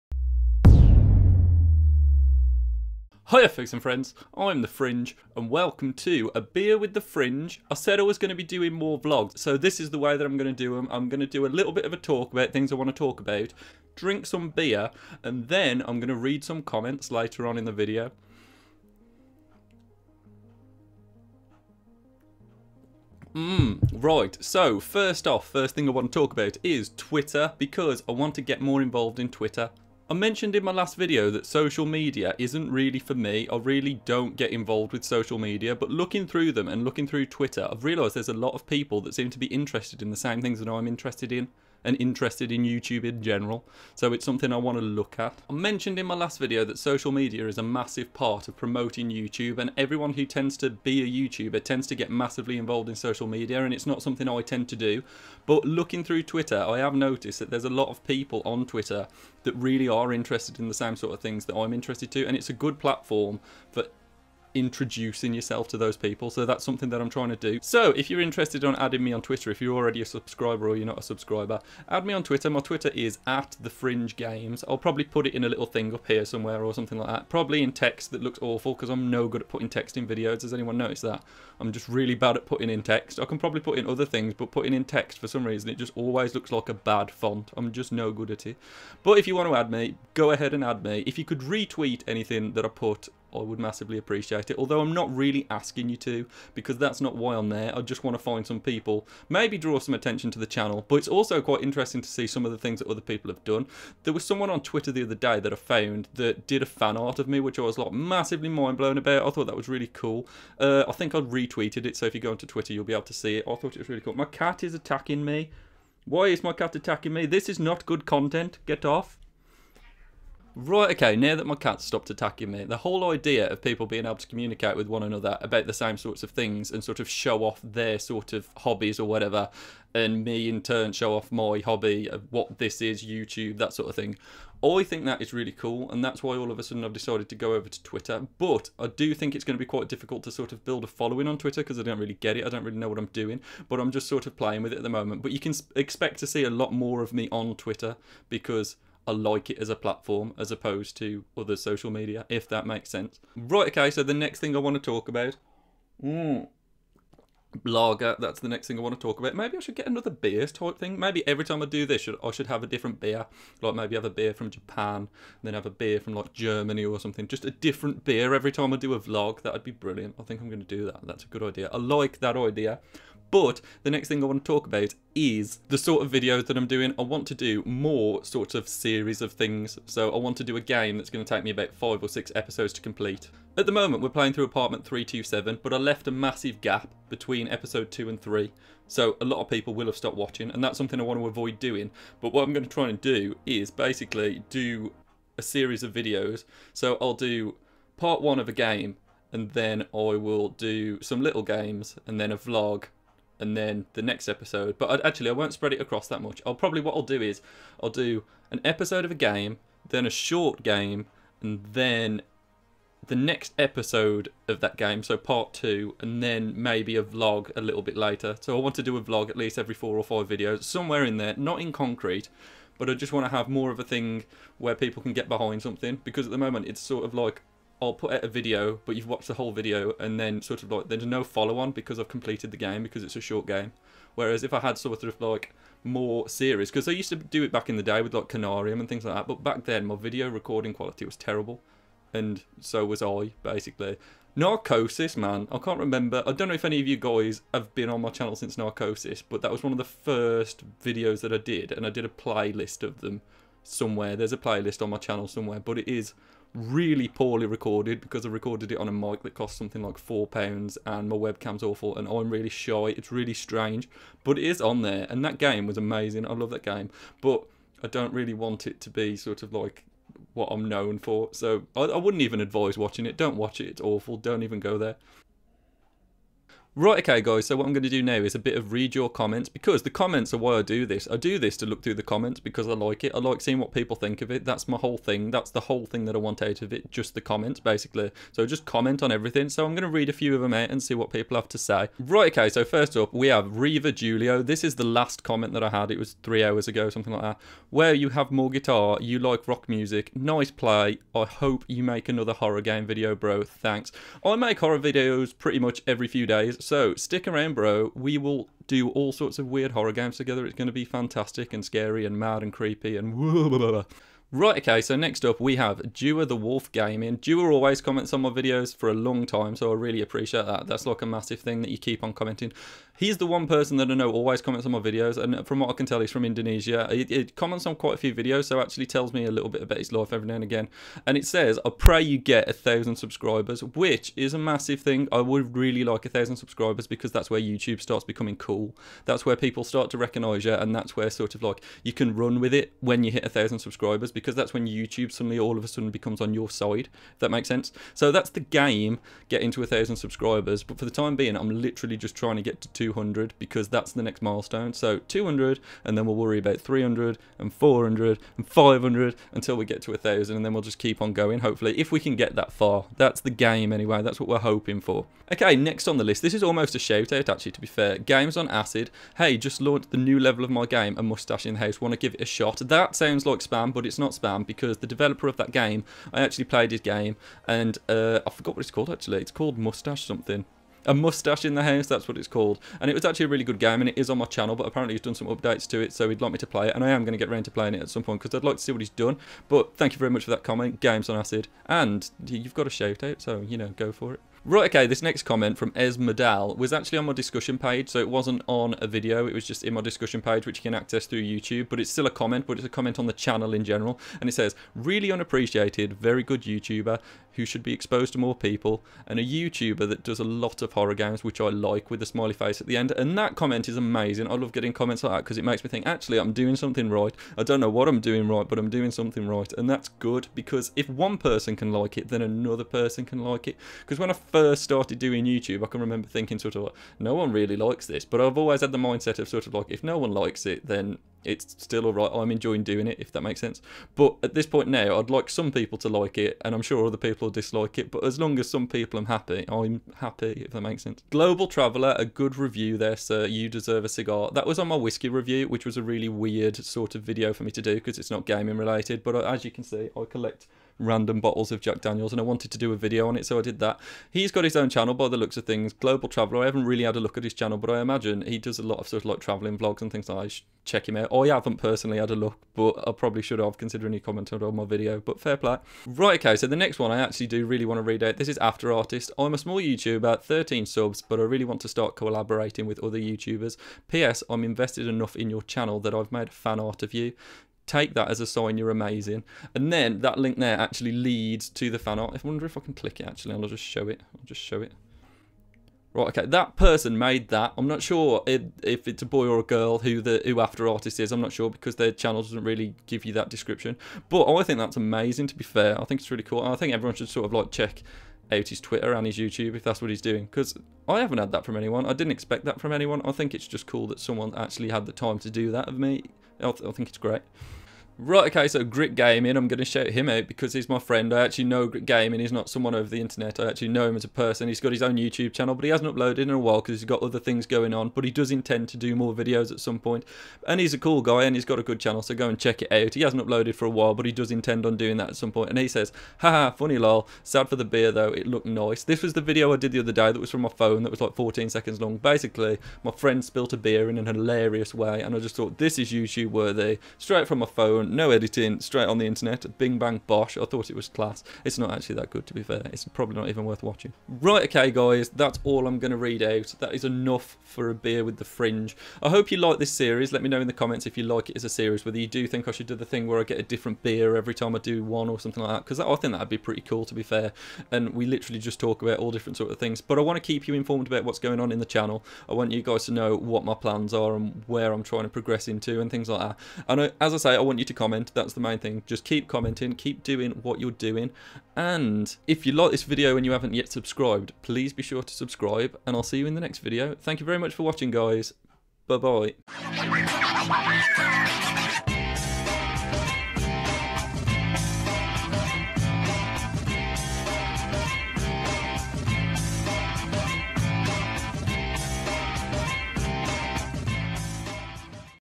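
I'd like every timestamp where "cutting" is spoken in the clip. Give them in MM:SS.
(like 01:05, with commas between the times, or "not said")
not said.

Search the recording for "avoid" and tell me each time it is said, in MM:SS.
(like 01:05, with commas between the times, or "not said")
03:11.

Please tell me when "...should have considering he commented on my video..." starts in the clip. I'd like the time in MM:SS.
07:43.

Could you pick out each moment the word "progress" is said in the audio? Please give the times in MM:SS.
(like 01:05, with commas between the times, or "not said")
09:25.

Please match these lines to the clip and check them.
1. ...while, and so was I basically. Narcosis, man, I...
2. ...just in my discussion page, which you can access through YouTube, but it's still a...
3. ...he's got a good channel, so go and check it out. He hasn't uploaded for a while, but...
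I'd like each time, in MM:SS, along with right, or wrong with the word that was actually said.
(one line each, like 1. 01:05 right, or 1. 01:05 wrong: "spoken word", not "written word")
1. 04:01 wrong: "terrible", not "while"
2. 06:39 right
3. 08:41 right.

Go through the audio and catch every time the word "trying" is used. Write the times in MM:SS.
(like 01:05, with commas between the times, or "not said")
01:07, 05:52, 09:24.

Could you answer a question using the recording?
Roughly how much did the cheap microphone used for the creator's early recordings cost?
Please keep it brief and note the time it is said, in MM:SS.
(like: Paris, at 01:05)
4 pounds, at 04:19.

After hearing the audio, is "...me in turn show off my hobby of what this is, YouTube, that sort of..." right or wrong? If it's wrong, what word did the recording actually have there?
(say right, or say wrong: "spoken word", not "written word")
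right.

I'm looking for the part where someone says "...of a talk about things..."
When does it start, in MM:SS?
00:11.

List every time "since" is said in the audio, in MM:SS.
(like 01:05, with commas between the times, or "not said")
04:08.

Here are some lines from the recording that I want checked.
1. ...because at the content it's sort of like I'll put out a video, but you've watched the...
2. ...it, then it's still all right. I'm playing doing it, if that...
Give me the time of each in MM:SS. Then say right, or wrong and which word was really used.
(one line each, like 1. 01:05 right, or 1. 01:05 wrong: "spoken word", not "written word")
1. 03:46 wrong: "moment", not "content"
2. 07:10 wrong: "enjoying", not "playing".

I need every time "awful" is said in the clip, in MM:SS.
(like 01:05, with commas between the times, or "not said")
01:18, 04:21, 04:33.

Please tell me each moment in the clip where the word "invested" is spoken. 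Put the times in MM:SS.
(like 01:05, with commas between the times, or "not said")
07:54.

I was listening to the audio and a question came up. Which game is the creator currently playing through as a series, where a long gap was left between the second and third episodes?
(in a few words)
Apartment 327.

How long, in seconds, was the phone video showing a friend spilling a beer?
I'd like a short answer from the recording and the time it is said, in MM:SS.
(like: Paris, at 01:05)
14, at 08:51.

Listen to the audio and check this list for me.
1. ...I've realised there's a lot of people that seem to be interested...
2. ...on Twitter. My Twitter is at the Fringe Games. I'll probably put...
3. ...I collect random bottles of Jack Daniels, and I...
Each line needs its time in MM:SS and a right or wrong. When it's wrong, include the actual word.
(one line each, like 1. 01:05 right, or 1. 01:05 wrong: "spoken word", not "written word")
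1. 00:37 right
2. 01:12 right
3. 07:29 right.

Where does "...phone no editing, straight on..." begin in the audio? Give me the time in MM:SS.
08:57.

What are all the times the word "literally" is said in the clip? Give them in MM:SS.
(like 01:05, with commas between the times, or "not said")
05:51, 09:18.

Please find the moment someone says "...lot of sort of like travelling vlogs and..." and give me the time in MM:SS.
07:38.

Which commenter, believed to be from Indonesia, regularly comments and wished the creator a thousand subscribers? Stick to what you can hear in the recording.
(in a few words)
Dua the Wolf Gaming.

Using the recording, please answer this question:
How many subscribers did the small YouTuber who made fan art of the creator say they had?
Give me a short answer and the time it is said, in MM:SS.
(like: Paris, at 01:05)
13, at 07:50.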